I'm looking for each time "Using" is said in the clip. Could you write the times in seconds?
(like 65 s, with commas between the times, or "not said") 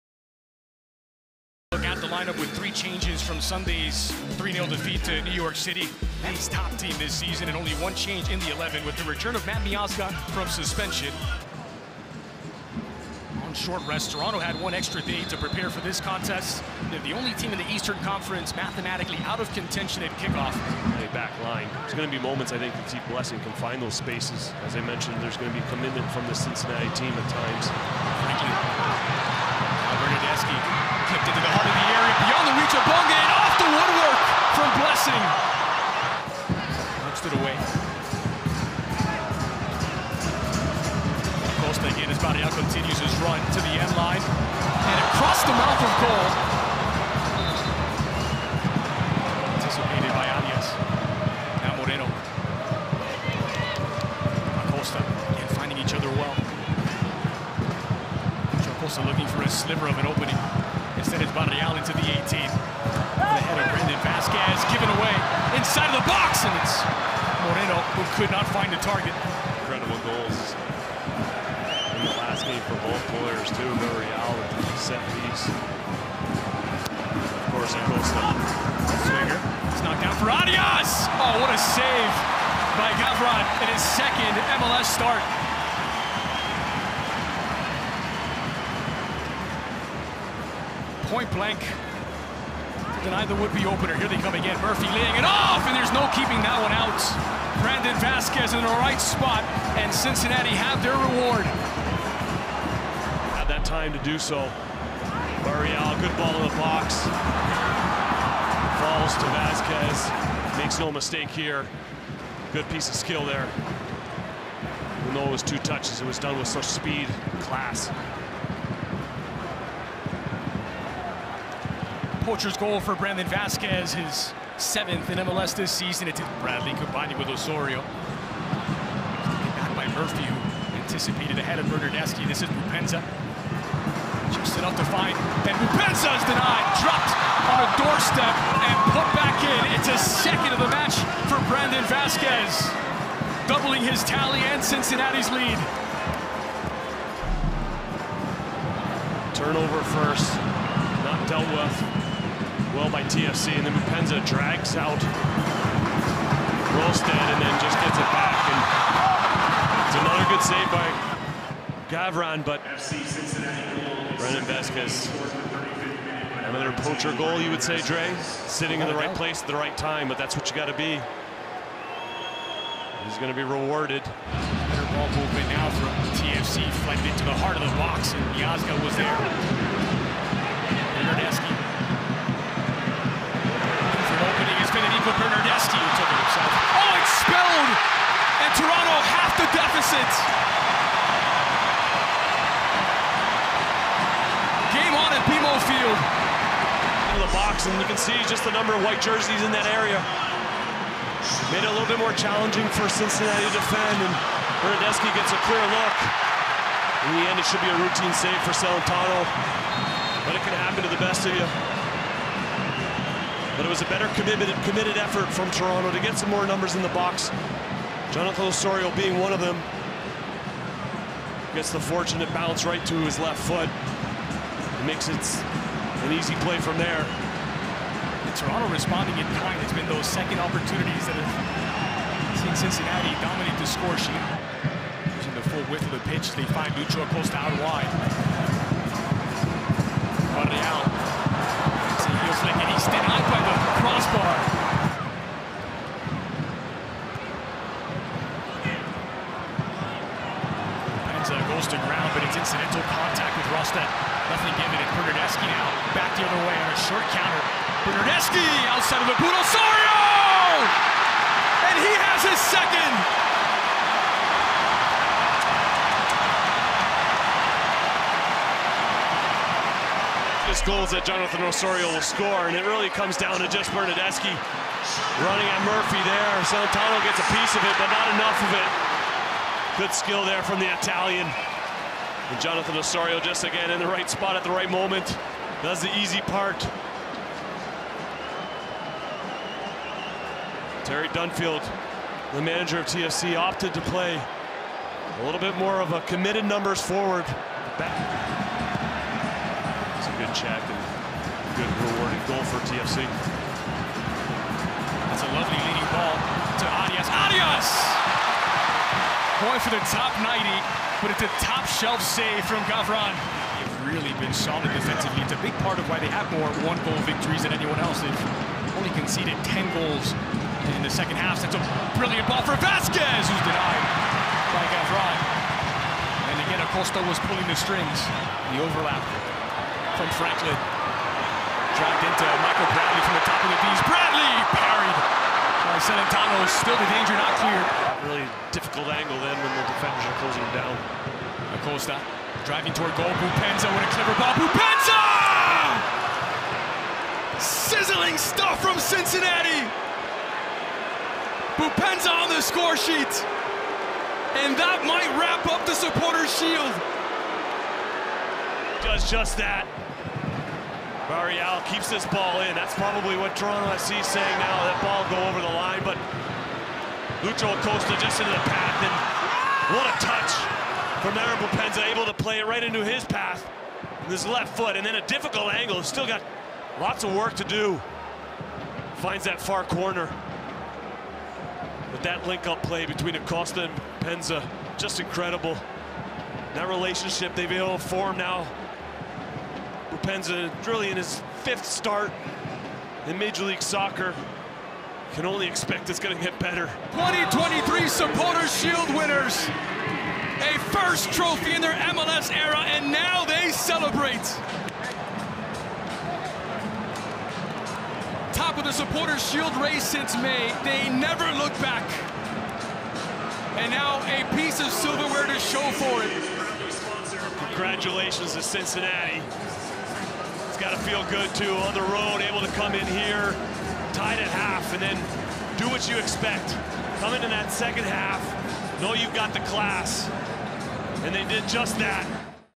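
235 s.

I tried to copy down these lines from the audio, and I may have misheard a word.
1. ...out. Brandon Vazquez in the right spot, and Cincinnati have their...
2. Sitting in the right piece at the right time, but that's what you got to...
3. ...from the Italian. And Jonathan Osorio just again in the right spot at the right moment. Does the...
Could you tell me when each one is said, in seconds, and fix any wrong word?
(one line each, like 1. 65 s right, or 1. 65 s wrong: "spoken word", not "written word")
1. 96 s right
2. 168 s wrong: "place", not "piece"
3. 280 s right.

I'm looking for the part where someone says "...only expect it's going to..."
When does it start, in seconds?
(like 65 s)
395 s.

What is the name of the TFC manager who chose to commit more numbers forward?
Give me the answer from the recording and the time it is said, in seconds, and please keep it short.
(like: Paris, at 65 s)
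Terry Dunfield, at 290 s.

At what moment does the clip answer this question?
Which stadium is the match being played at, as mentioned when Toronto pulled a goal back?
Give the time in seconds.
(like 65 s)
195 s.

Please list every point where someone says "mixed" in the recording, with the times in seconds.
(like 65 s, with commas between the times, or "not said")
not said.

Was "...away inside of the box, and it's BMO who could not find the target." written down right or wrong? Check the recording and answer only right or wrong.
wrong.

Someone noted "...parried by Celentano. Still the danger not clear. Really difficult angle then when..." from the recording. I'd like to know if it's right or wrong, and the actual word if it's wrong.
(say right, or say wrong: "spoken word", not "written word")
right.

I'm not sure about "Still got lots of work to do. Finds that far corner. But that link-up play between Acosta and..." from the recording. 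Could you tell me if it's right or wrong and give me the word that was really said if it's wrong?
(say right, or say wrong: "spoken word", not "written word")
right.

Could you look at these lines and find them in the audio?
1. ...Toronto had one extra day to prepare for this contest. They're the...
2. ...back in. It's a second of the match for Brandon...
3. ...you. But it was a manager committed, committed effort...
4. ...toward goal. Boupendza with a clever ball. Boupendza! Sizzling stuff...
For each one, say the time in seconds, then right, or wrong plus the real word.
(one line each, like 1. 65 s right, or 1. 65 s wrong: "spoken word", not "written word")
1. 14 s right
2. 139 s right
3. 211 s wrong: "better", not "manager"
4. 342 s right.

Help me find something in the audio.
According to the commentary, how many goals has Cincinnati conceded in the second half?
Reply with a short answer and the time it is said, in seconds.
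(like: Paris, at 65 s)
10, at 319 s.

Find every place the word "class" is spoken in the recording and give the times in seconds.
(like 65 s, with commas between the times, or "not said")
117 s, 429 s.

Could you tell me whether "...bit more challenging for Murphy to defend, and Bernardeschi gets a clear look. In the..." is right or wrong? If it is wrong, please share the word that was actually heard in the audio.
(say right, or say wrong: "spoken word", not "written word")
wrong: "Cincinnati", not "Murphy".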